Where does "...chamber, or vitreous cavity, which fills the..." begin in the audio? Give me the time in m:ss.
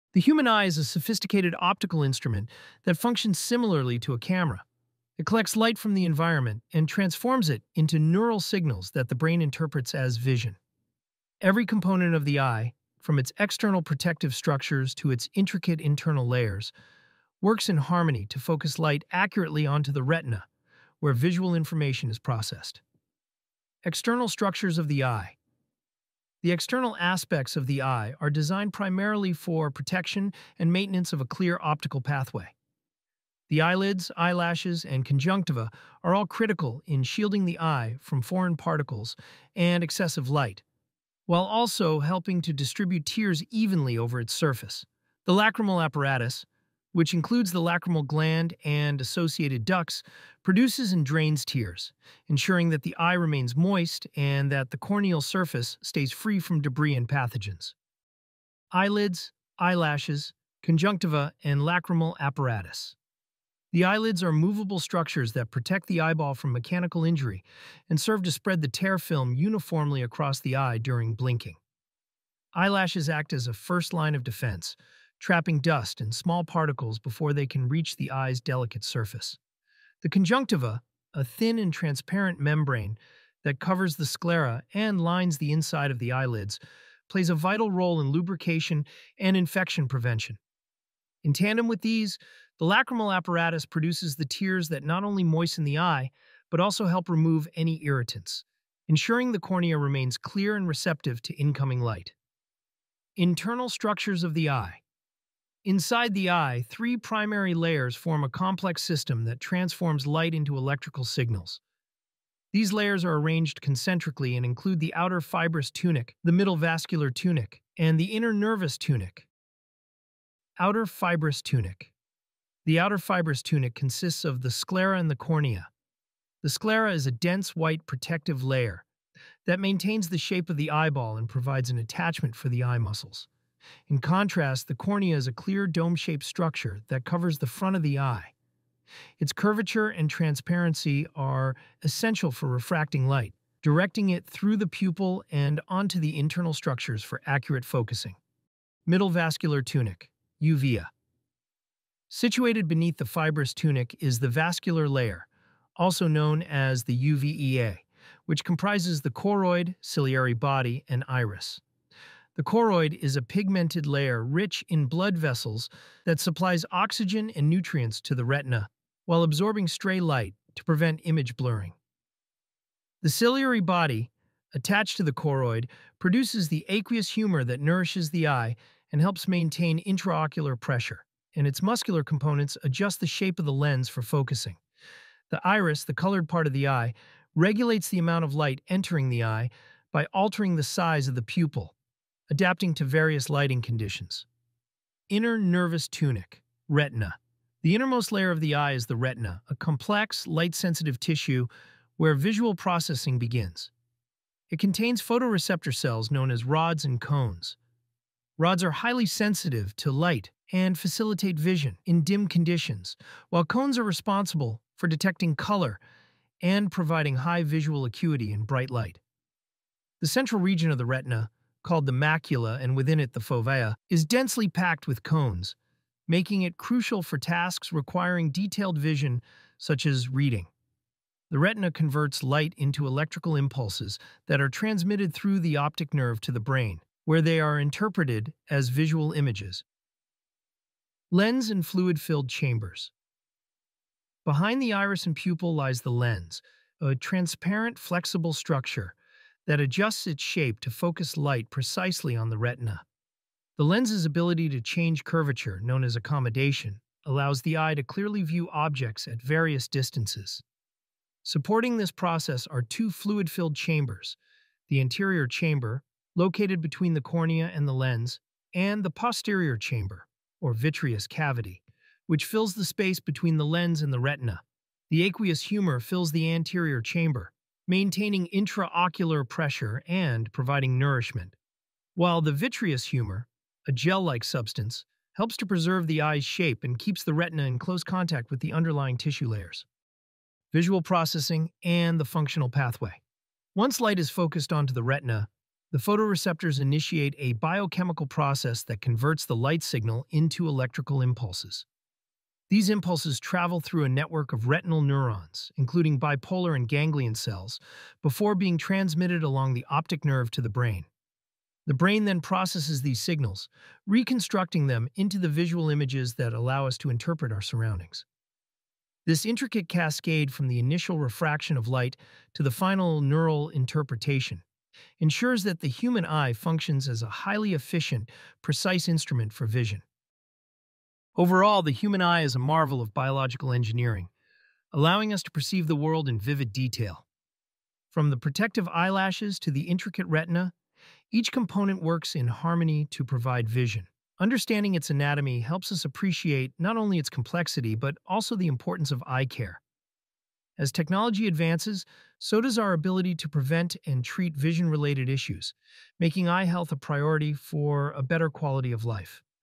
4:29.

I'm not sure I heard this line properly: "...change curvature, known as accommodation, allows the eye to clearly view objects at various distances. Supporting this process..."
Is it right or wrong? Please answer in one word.
right.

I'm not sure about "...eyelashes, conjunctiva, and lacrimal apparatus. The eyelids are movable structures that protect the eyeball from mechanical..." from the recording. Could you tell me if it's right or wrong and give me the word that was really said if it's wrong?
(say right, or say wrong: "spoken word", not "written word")
right.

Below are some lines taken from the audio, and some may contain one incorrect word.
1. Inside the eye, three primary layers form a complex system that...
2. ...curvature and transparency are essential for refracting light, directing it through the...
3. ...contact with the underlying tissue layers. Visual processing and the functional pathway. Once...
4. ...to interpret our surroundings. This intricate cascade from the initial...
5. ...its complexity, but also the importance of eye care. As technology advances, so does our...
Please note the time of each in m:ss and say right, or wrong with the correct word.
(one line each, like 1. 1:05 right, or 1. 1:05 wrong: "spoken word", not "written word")
1. 1:45 right
2. 2:19 right
3. 4:47 right
4. 5:16 right
5. 5:46 right.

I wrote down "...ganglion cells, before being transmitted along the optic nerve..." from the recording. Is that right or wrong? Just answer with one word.
right.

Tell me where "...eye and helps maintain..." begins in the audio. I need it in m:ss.
2:58.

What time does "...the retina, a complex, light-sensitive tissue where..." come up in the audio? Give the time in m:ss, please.
3:18.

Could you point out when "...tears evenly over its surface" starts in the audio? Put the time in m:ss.
0:43.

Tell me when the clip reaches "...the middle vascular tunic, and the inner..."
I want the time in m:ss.
1:56.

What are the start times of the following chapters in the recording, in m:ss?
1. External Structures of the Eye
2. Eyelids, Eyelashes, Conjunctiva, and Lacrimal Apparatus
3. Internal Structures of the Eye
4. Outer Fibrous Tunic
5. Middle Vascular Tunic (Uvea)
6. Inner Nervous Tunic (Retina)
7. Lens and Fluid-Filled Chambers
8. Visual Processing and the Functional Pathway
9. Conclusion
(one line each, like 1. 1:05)
1. 0:23
2. 0:58
3. 1:43
4. 2:00
5. 2:28
6. 3:15
7. 4:00
8. 4:50
9. 5:31.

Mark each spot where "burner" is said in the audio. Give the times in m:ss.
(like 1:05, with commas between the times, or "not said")
not said.